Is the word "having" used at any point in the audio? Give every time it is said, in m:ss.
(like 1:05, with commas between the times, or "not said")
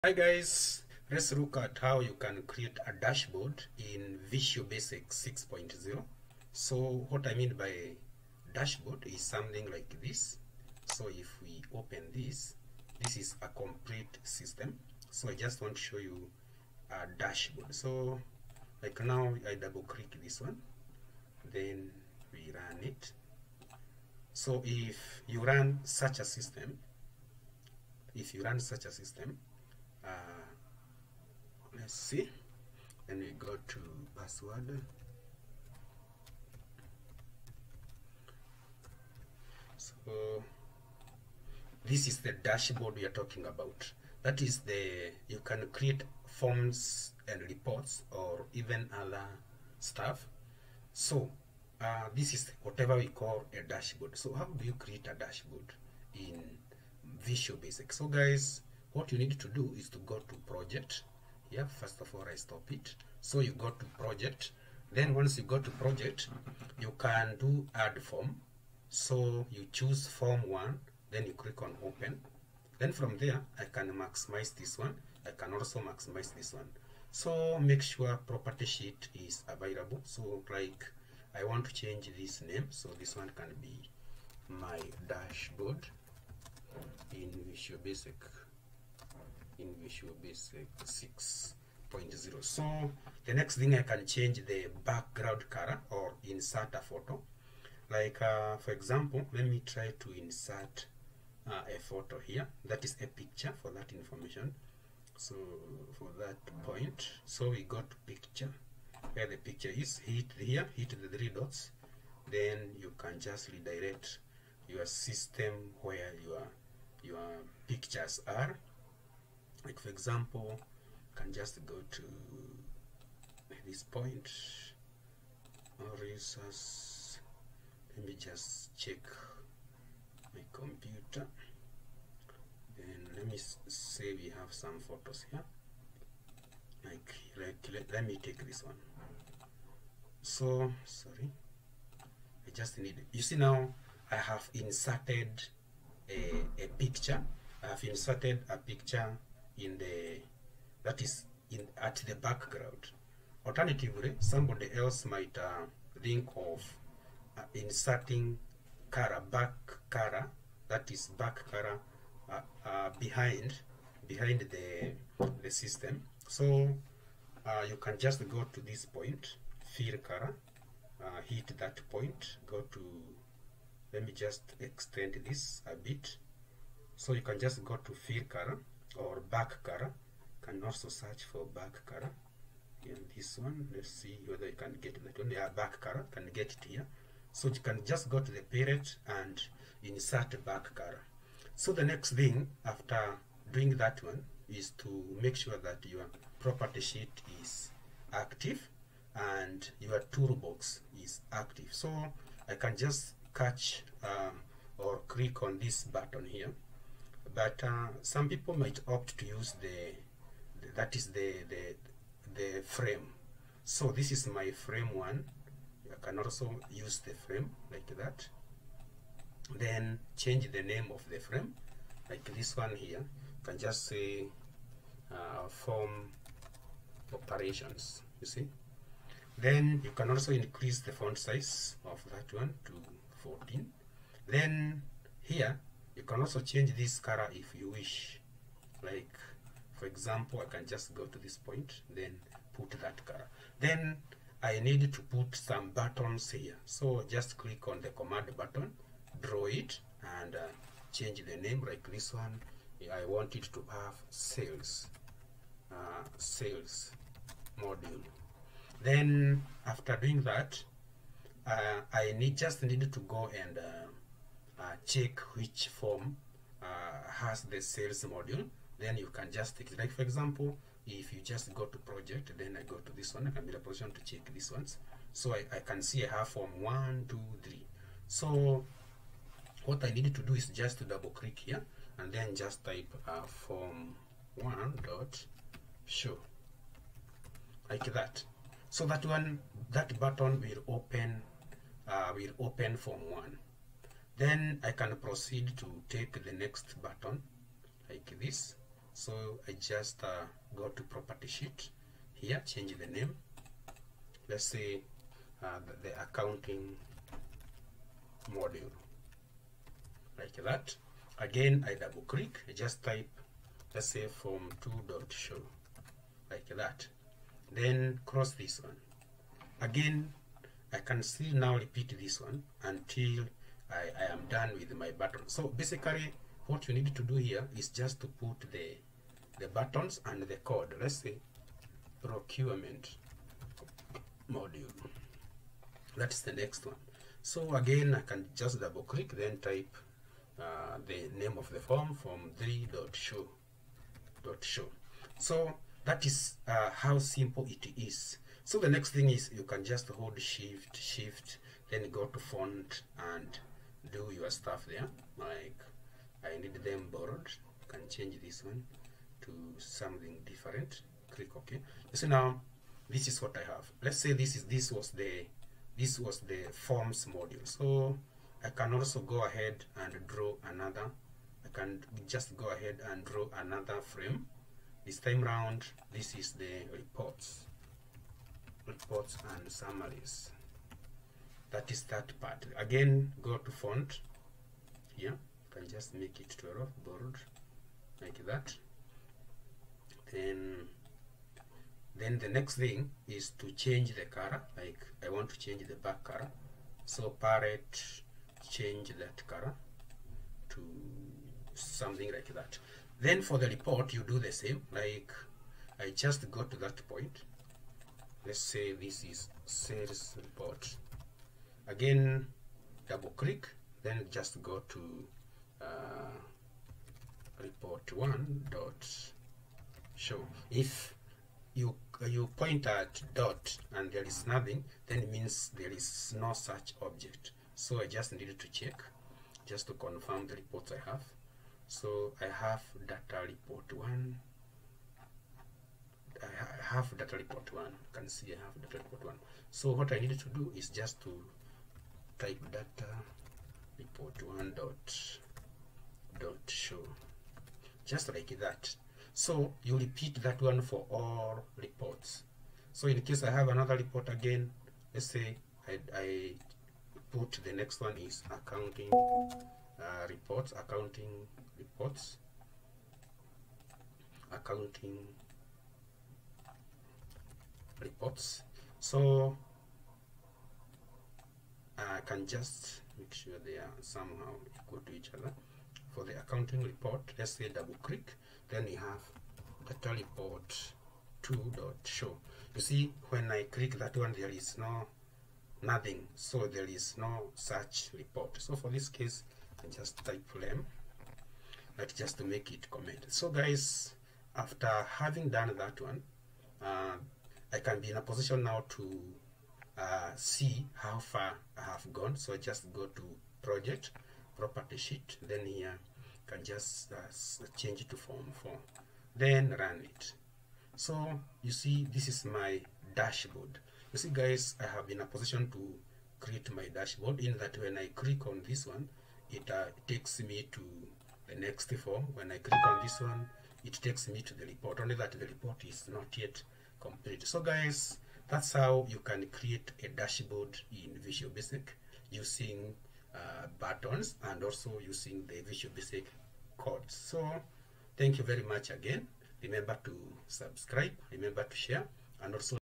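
8:14.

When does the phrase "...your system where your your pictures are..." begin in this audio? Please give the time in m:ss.
1:54.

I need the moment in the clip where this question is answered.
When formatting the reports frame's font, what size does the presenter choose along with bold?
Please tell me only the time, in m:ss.
6:26.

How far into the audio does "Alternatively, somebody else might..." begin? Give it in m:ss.
2:33.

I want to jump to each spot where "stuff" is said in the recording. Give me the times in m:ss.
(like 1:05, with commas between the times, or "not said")
0:49, 5:54.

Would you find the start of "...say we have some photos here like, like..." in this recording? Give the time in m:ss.
2:13.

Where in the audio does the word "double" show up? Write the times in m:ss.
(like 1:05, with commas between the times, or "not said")
0:19, 4:40, 5:11, 5:38, 6:52, 7:57.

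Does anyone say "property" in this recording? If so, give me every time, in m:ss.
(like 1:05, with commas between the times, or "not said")
1:18, 3:16, 5:00, 8:24.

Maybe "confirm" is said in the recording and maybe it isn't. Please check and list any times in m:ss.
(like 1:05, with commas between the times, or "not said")
7:09.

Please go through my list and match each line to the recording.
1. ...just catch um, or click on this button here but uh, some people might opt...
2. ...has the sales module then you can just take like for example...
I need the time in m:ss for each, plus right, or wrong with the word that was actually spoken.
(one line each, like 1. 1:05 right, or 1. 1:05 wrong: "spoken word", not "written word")
1. 3:22 right
2. 4:27 right.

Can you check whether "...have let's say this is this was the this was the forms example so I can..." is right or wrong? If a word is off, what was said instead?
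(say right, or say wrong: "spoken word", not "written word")
wrong: "module", not "example".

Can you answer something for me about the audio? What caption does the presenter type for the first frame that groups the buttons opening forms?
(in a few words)
form operations.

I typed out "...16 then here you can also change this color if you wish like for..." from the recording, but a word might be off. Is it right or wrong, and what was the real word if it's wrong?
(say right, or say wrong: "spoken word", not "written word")
wrong: "14", not "16".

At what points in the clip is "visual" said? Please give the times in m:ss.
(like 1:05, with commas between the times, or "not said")
0:04, 0:57, 1:27, 8:51, 8:55.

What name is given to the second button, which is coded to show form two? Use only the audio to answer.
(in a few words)
accounting module.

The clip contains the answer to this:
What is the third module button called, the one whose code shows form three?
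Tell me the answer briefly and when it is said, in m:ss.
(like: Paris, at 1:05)
procurement module, at 5:32.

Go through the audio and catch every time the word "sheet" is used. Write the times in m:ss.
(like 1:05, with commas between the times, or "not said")
1:18, 3:16, 5:01, 8:24.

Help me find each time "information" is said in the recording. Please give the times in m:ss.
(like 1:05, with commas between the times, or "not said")
1:43.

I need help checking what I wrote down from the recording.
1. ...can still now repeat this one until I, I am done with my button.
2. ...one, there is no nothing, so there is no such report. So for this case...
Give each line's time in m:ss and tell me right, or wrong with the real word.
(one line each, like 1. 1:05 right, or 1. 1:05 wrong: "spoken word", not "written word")
1. 5:20 right
2. 8:03 right.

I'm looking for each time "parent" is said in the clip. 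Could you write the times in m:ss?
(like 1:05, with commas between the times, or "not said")
3:08.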